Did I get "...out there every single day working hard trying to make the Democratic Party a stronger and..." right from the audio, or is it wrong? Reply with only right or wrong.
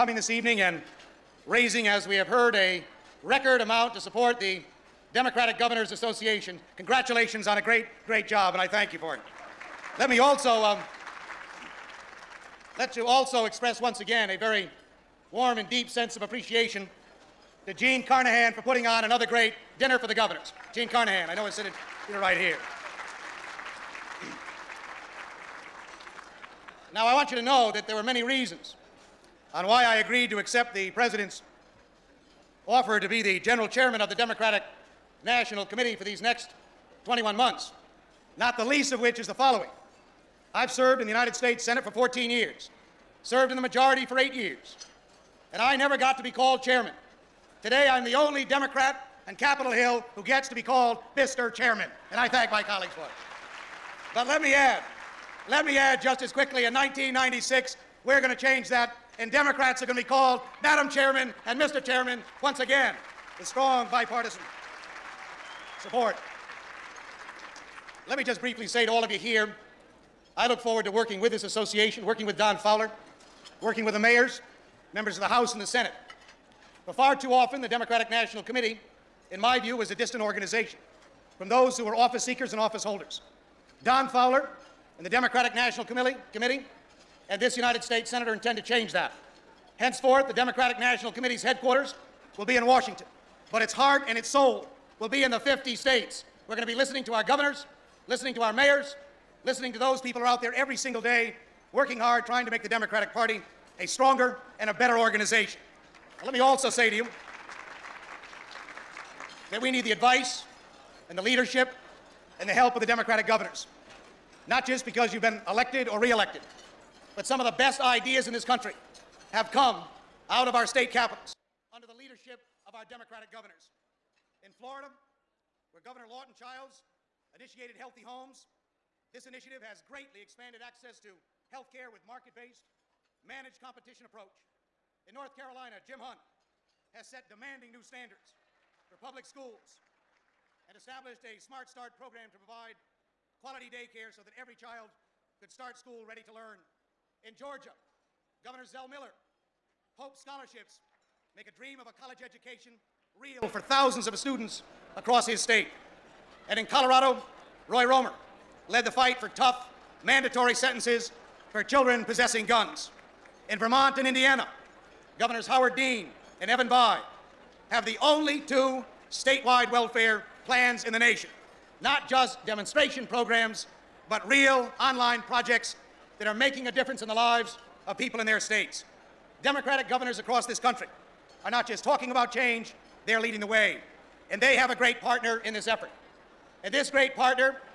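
right.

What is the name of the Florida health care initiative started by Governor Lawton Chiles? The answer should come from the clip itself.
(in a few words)
Healthy Homes.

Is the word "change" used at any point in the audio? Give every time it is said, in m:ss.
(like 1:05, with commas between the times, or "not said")
0:58, 1:28, 3:02.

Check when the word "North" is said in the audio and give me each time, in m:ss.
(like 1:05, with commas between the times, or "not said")
2:15.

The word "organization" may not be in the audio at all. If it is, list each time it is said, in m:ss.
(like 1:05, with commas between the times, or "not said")
1:20, 1:44.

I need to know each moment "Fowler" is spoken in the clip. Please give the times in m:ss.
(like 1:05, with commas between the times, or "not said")
1:12, 1:24.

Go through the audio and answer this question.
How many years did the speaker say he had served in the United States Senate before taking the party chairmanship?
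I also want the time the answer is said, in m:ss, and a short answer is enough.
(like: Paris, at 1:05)
14, at 0:41.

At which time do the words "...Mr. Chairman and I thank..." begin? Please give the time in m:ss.
0:51.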